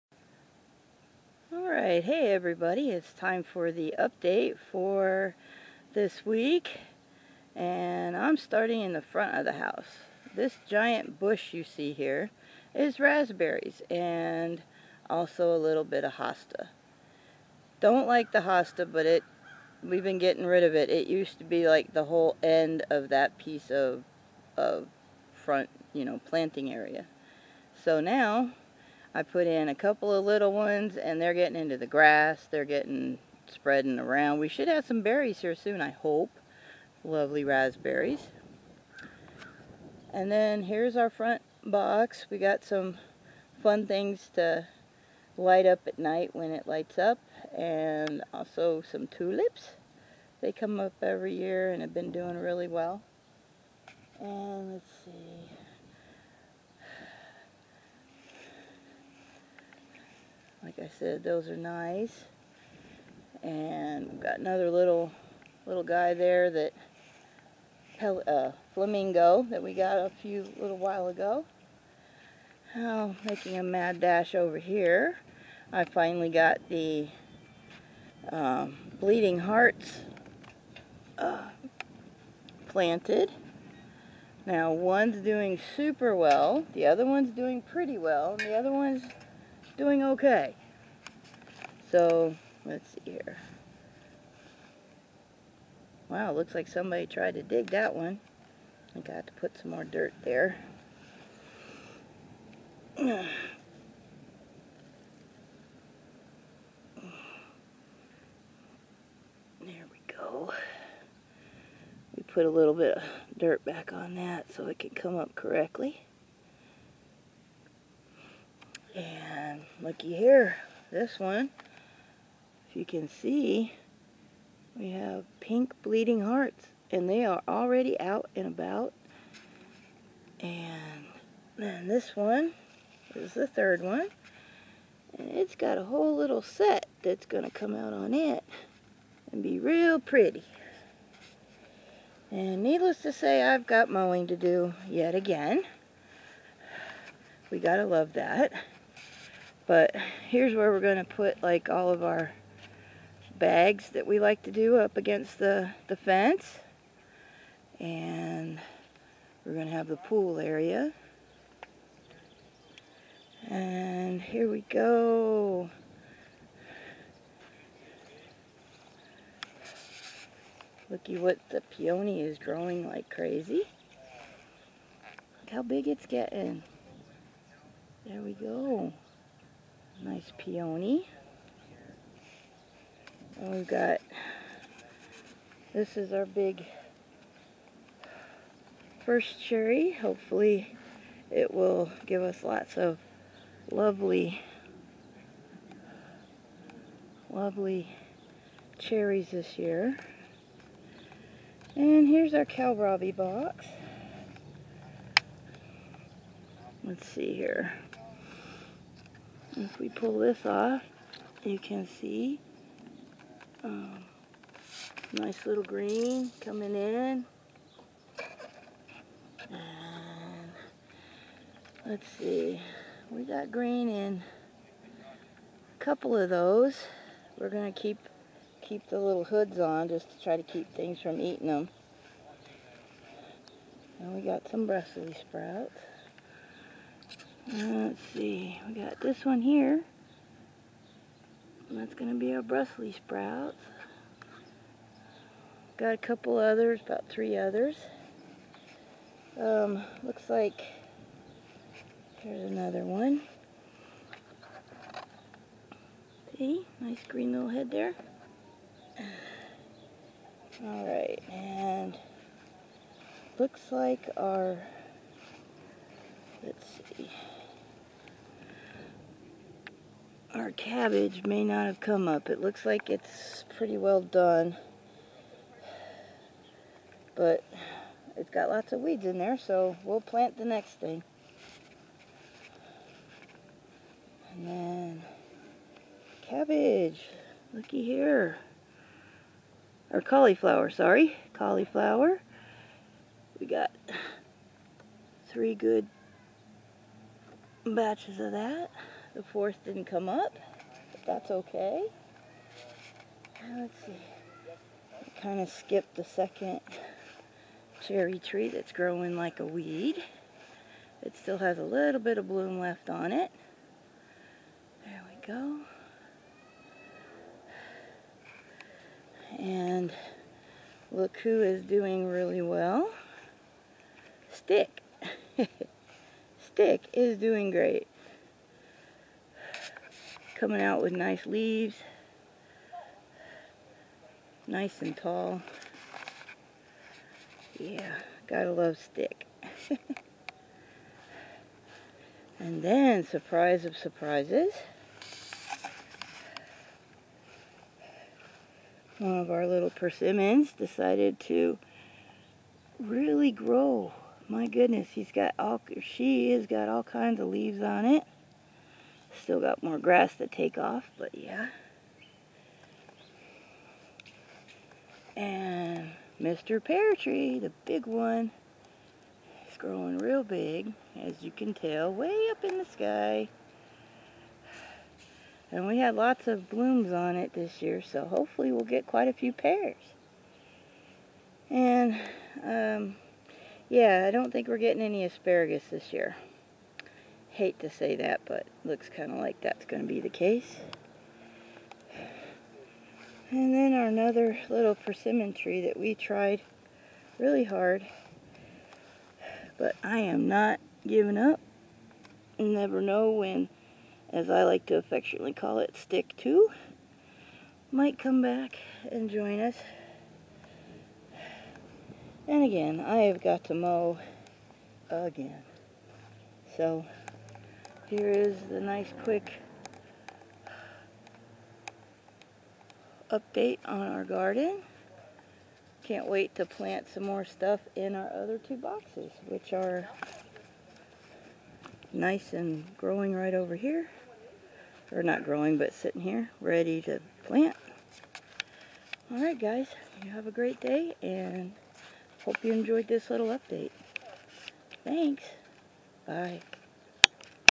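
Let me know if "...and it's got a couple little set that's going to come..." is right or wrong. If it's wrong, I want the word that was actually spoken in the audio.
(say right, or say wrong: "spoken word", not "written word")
wrong: "whole", not "couple".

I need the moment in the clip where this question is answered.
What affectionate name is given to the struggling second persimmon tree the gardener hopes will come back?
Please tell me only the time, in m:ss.
6:45.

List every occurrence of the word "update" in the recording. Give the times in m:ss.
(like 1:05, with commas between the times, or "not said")
0:03, 7:03, 7:23.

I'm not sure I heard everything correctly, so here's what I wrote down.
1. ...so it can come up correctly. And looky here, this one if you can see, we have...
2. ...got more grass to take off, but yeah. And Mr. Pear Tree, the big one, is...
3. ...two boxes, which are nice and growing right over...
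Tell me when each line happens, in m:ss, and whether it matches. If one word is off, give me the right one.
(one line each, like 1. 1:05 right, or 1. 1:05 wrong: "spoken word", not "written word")
1. 1:54 right
2. 5:59 right
3. 7:08 right.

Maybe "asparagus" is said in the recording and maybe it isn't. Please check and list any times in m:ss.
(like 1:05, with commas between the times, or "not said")
6:25.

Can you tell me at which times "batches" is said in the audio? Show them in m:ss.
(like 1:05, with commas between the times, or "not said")
4:57.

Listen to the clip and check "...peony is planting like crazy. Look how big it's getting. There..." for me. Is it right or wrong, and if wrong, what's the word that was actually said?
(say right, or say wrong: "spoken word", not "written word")
wrong: "growing", not "planting".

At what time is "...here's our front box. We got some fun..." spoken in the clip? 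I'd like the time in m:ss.
0:40.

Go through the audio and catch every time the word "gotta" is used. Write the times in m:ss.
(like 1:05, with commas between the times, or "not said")
2:27, 5:38.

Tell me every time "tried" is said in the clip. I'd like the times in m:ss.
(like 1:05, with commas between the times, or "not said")
1:37, 6:35.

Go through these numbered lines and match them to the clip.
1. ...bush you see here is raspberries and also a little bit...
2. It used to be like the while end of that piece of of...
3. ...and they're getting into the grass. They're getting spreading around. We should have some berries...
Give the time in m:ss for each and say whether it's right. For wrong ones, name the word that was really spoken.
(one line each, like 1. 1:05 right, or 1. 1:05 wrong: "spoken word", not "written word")
1. 0:11 right
2. 0:20 wrong: "whole", not "while"
3. 0:30 right.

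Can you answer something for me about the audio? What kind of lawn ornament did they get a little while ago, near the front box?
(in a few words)
Flamingo.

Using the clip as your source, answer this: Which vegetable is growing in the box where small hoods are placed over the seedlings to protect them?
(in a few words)
Kohlrabi.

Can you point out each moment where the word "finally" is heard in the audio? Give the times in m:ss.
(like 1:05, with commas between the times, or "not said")
1:15.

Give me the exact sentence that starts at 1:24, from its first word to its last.
Now one's doing super well, the other one's doing pretty well, and the other one's doing okay.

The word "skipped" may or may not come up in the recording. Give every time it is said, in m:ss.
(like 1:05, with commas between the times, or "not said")
5:05.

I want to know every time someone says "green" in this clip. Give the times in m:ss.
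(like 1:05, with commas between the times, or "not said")
3:35, 3:43, 4:17.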